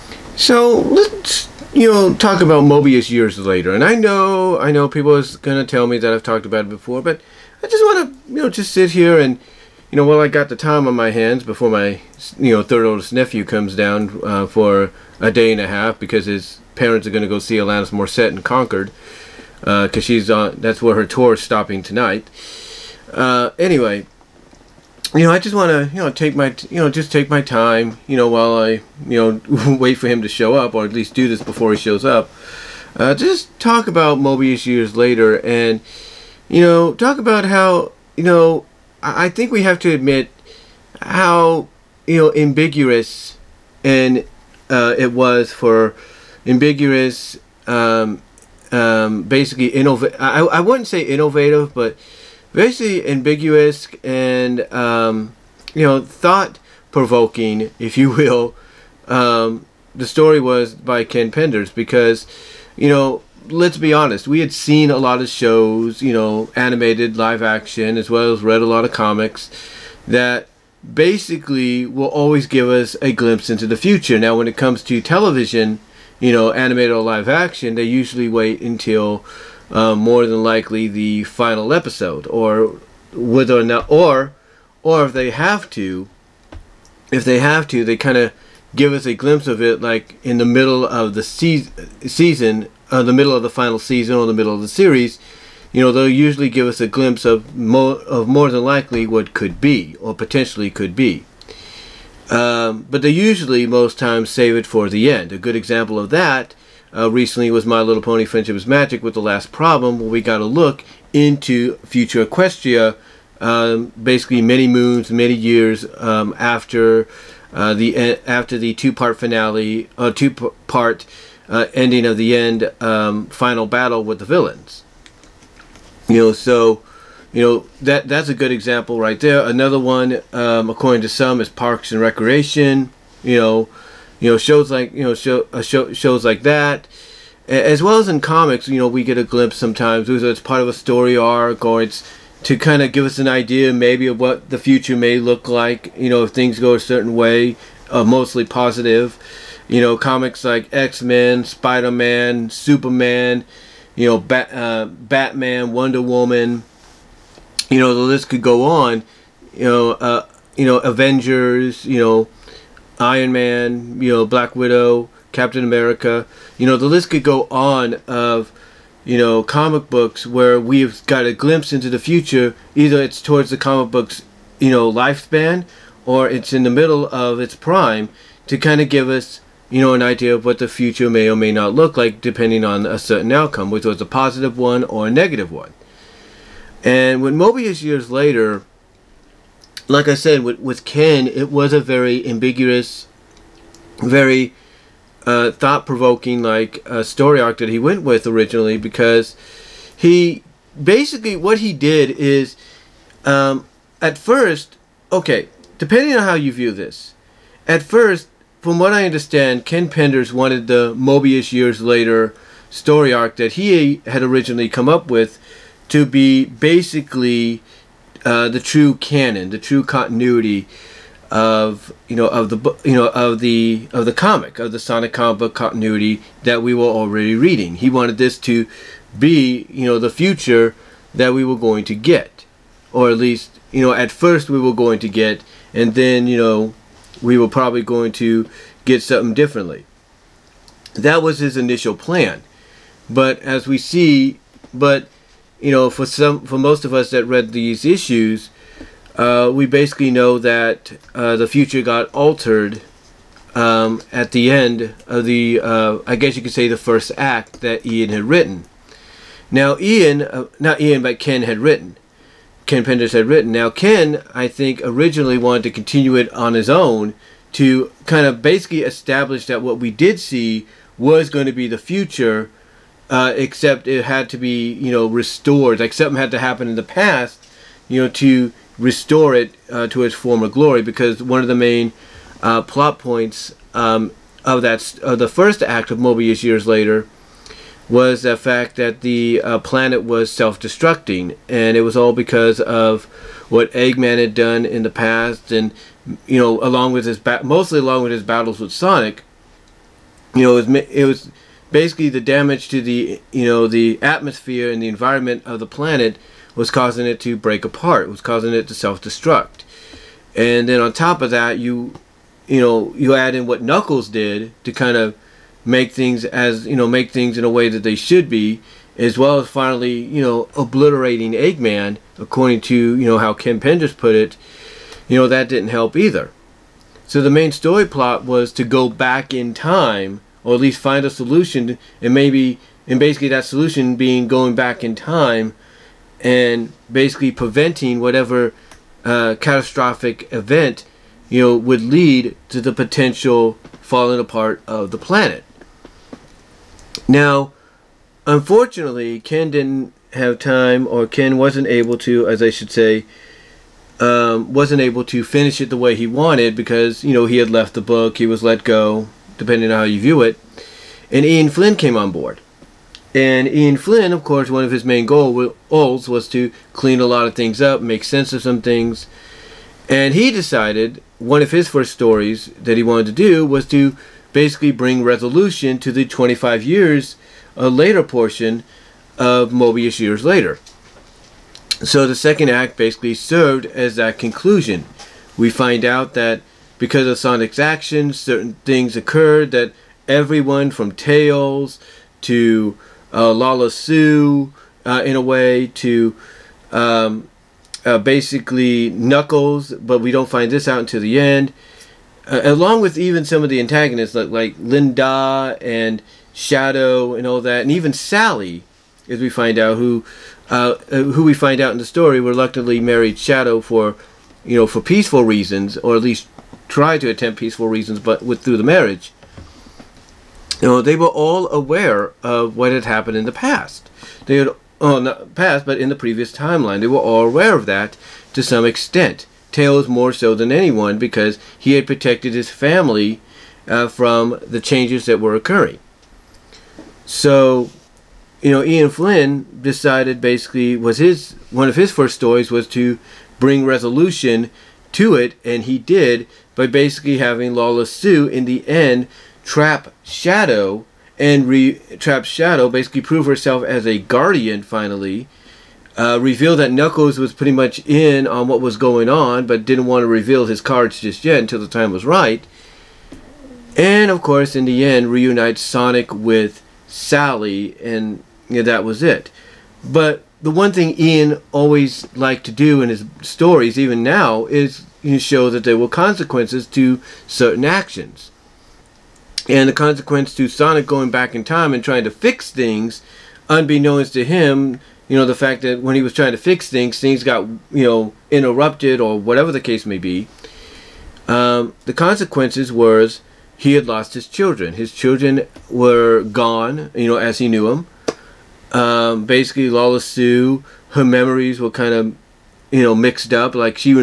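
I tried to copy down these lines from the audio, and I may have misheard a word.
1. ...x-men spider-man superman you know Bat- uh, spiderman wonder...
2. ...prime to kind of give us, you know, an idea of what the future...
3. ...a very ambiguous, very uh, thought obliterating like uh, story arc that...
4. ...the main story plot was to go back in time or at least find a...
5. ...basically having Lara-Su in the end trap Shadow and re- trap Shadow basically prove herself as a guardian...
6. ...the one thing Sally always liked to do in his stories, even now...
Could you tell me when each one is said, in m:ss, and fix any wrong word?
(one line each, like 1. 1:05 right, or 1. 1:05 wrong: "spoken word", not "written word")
1. 2:30 wrong: "batman", not "spiderman"
2. 2:57 right
3. 3:11 wrong: "provoking", not "obliterating"
4. 5:27 right
5. 7:26 right
6. 7:50 wrong: "Ian", not "Sally".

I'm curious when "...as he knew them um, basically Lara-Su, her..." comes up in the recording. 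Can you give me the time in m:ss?
8:17.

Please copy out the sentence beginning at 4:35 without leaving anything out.
Like something had to happen in the past, you know, to restore it uh, to its former glory.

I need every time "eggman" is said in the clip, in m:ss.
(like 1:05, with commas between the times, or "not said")
4:53, 5:21.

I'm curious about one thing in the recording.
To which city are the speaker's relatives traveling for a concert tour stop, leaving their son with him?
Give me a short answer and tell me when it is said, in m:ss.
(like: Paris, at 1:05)
Concord, at 0:18.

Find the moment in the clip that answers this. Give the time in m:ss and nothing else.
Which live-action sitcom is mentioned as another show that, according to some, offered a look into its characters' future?
2:11.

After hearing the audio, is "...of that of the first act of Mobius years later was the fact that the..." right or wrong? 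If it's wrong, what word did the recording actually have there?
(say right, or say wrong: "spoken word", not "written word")
right.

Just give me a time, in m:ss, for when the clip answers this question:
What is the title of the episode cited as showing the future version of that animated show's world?
1:49.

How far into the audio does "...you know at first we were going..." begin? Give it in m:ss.
3:53.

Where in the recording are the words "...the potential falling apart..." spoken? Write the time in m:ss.
5:42.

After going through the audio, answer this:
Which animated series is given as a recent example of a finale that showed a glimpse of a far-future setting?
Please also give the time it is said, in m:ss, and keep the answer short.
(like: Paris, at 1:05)
My Little Pony Friendship is Magic, at 1:47.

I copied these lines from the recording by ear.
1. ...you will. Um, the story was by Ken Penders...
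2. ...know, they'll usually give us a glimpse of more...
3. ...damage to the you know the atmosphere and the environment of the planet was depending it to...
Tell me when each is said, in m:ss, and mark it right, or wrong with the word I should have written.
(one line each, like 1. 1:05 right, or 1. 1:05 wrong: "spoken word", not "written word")
1. 0:57 right
2. 1:35 right
3. 5:02 wrong: "causing", not "depending".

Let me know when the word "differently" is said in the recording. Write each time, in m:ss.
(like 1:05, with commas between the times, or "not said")
3:59.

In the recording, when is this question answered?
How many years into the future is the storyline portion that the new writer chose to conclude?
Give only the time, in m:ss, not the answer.
6:16.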